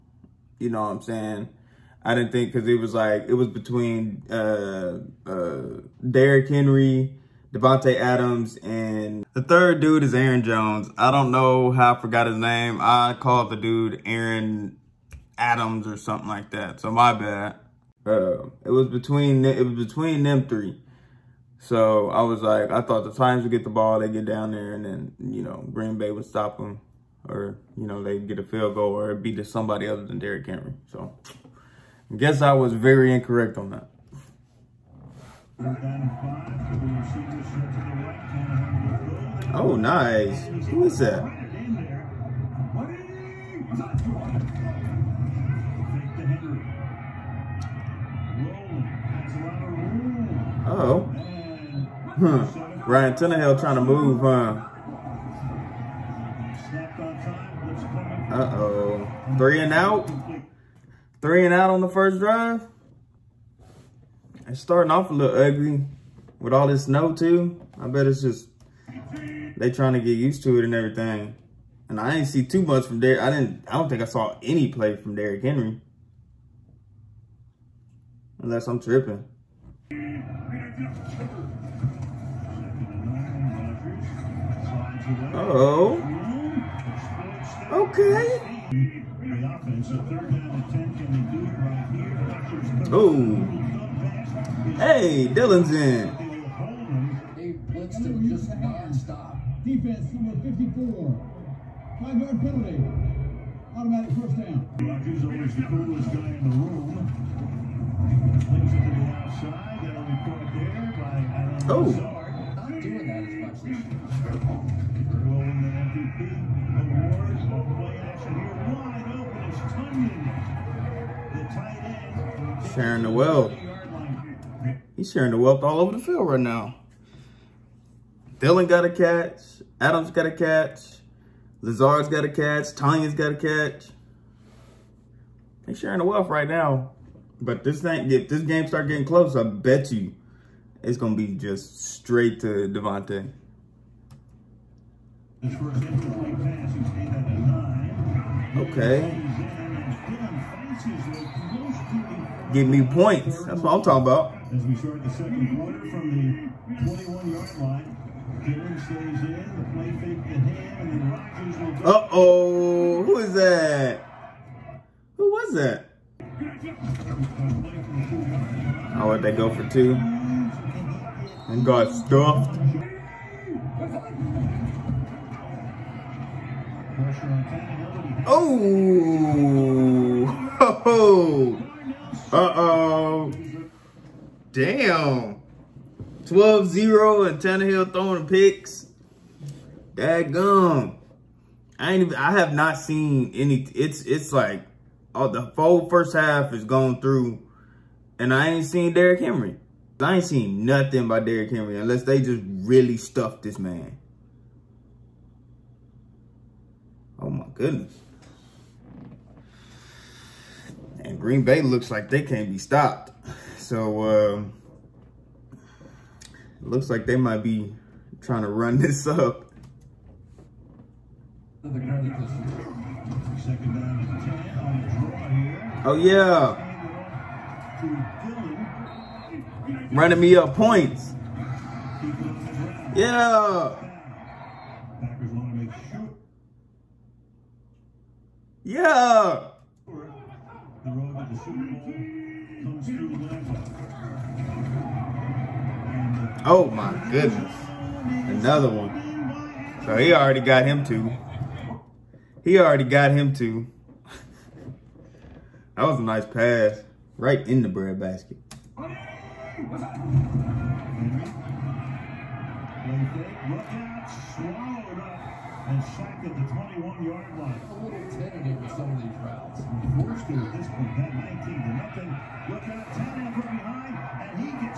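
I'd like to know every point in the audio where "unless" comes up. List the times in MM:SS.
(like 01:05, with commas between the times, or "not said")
01:18, 03:21.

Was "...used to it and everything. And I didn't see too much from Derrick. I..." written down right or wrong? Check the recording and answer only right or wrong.
right.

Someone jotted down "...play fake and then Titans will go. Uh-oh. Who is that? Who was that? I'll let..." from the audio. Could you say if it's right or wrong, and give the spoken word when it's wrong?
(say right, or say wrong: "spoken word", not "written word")
wrong: "Rodgers", not "Titans".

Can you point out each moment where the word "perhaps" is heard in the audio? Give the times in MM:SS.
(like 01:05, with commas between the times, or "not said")
not said.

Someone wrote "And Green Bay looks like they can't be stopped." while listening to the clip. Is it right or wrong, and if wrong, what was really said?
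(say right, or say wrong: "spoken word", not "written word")
right.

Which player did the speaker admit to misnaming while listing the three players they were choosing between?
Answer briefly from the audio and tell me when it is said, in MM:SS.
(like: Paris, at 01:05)
Aaron Jones, at 00:10.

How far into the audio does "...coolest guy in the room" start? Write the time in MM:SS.
01:45.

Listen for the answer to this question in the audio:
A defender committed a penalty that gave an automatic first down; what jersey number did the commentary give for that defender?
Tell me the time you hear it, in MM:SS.
01:40.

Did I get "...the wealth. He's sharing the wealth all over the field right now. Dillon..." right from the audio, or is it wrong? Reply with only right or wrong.
right.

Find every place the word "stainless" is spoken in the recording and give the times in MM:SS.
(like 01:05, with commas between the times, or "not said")
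not said.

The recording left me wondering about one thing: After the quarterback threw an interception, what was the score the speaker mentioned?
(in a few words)
12-0.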